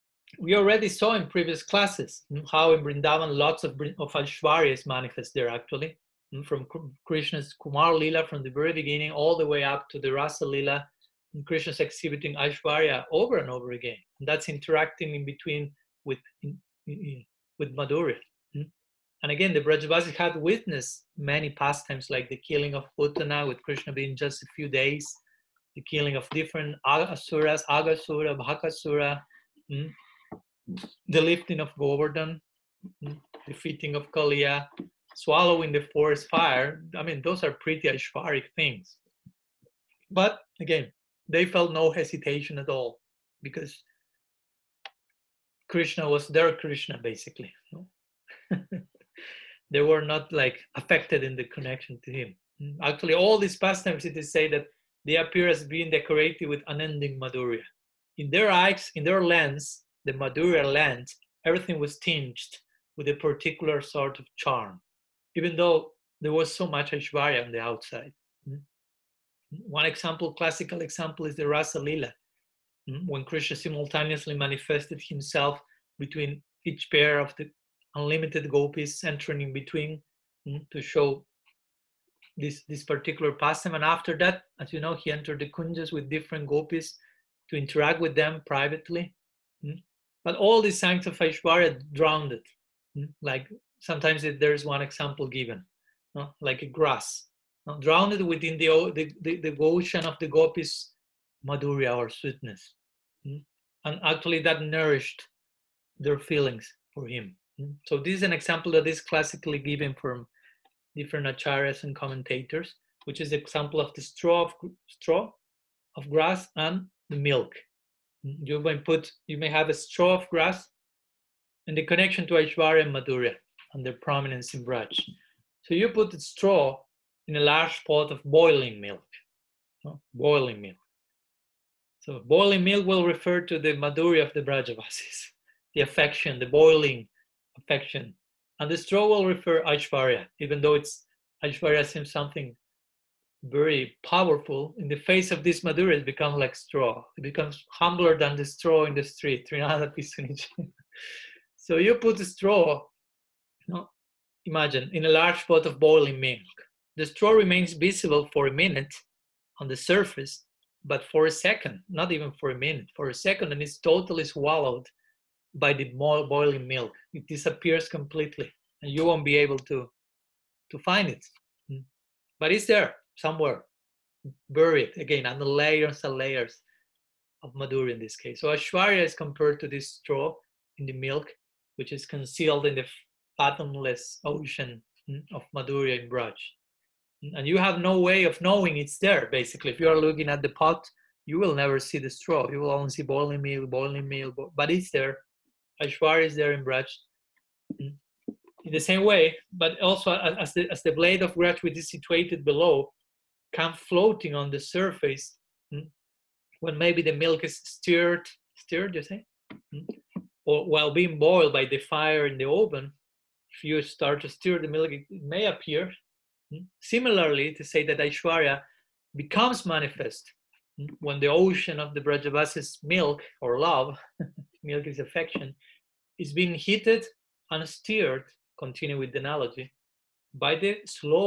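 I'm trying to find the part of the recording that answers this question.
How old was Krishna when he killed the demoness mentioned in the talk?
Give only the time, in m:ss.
0:24.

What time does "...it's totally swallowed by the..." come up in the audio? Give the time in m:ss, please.
2:43.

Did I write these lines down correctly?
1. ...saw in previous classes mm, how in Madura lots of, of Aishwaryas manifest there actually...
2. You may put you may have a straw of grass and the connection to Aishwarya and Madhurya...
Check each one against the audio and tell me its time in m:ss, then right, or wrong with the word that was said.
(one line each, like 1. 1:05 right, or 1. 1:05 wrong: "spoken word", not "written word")
1. 0:00 wrong: "Brindavan", not "Madura"
2. 1:58 right.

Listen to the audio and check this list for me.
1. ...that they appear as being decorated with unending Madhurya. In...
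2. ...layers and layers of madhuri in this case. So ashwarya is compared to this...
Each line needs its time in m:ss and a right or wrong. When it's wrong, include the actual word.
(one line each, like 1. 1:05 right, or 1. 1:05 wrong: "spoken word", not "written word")
1. 0:54 right
2. 2:55 right.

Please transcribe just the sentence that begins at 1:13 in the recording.
when Krishna simultaneously manifested himself between each pair of the unlimited gopis entering in between mm, to show this this particular pastime.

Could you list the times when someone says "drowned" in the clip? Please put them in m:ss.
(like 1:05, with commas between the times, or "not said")
1:31, 1:37.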